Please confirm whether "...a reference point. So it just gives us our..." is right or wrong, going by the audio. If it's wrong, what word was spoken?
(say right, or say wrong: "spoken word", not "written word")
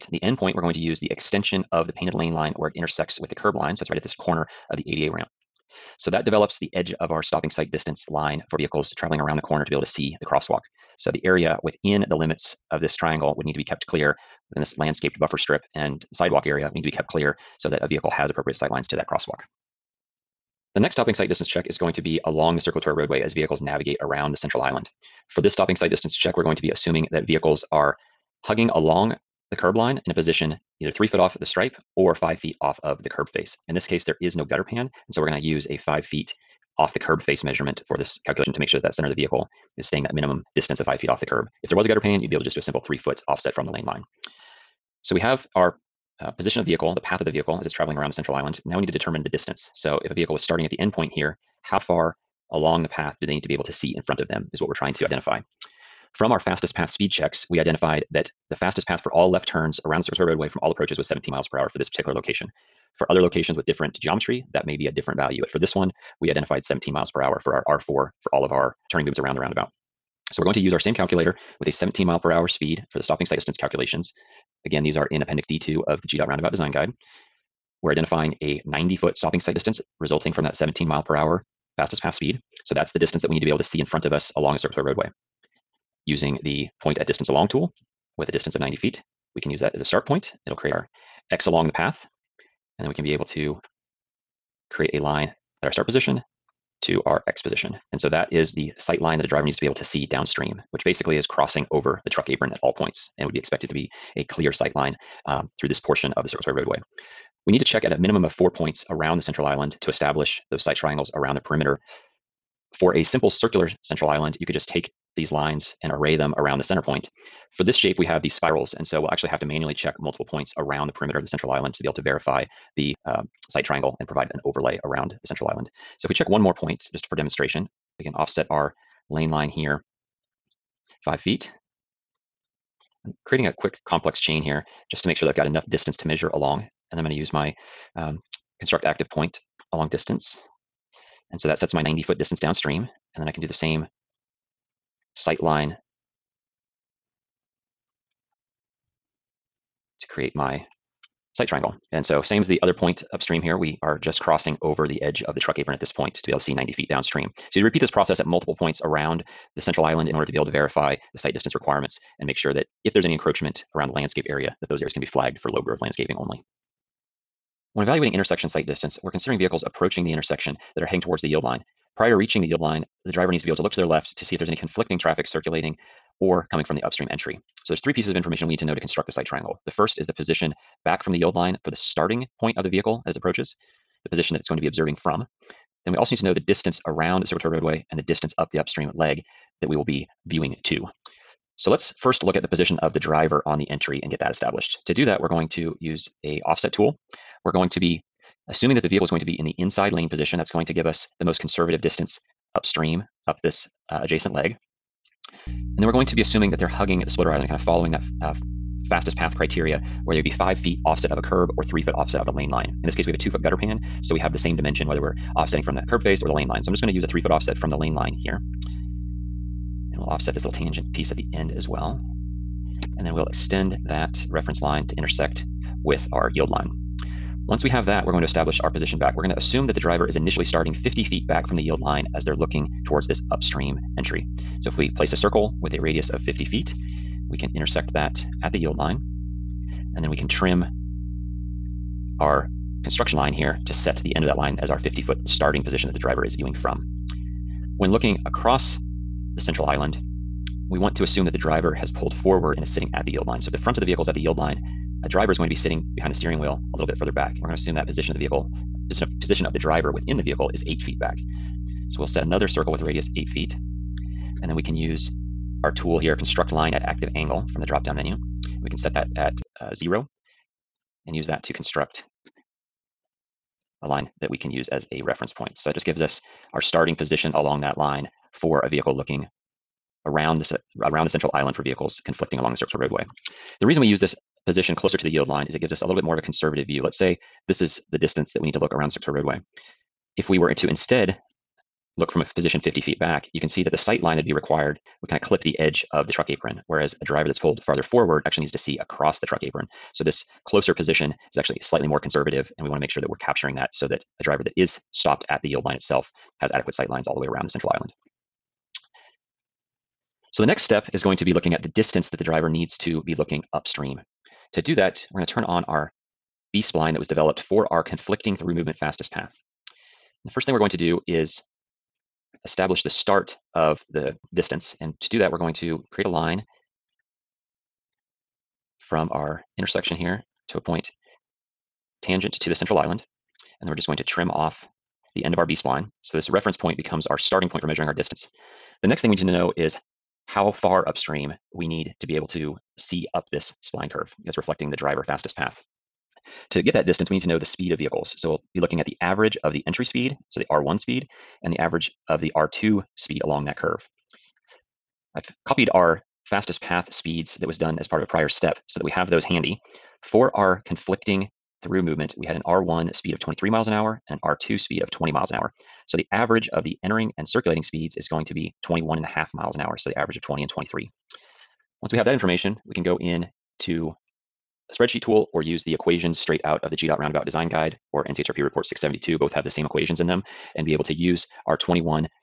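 right.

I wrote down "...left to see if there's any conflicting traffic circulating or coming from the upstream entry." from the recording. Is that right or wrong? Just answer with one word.
right.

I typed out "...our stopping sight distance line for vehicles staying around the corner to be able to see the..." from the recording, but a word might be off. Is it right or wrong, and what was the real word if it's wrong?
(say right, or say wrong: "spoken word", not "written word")
wrong: "traveling", not "staying".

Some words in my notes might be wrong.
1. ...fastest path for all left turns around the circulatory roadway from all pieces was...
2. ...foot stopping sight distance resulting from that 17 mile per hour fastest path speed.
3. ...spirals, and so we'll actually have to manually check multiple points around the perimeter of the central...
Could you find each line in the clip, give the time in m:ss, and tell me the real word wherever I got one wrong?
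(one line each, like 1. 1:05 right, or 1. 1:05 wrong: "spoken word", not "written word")
1. 0:58 wrong: "approaches", not "pieces"
2. 1:18 right
3. 1:58 right.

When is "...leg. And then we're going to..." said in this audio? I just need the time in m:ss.
3:24.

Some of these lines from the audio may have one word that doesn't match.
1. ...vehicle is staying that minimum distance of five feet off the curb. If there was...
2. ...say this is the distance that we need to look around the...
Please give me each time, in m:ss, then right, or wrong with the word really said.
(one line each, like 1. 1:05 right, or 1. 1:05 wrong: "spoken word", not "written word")
1. 0:39 right
2. 4:46 right.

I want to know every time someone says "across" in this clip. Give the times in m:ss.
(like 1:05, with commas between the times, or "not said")
4:08, 4:58.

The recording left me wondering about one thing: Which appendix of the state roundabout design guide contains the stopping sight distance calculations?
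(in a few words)
Appendix D2.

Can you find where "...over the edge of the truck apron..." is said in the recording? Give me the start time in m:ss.
2:34.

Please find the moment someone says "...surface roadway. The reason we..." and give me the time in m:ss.
4:42.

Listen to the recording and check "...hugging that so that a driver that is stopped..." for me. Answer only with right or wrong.
wrong.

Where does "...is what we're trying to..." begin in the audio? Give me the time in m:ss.
0:54.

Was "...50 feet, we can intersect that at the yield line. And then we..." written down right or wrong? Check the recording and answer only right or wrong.
right.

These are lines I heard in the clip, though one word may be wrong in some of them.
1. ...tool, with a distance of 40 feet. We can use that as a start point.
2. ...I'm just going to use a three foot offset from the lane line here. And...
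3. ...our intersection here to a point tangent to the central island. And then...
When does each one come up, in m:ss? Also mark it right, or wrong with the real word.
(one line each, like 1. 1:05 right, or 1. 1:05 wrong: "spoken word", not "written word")
1. 1:27 wrong: "90", not "40"
2. 3:36 right
3. 5:29 right.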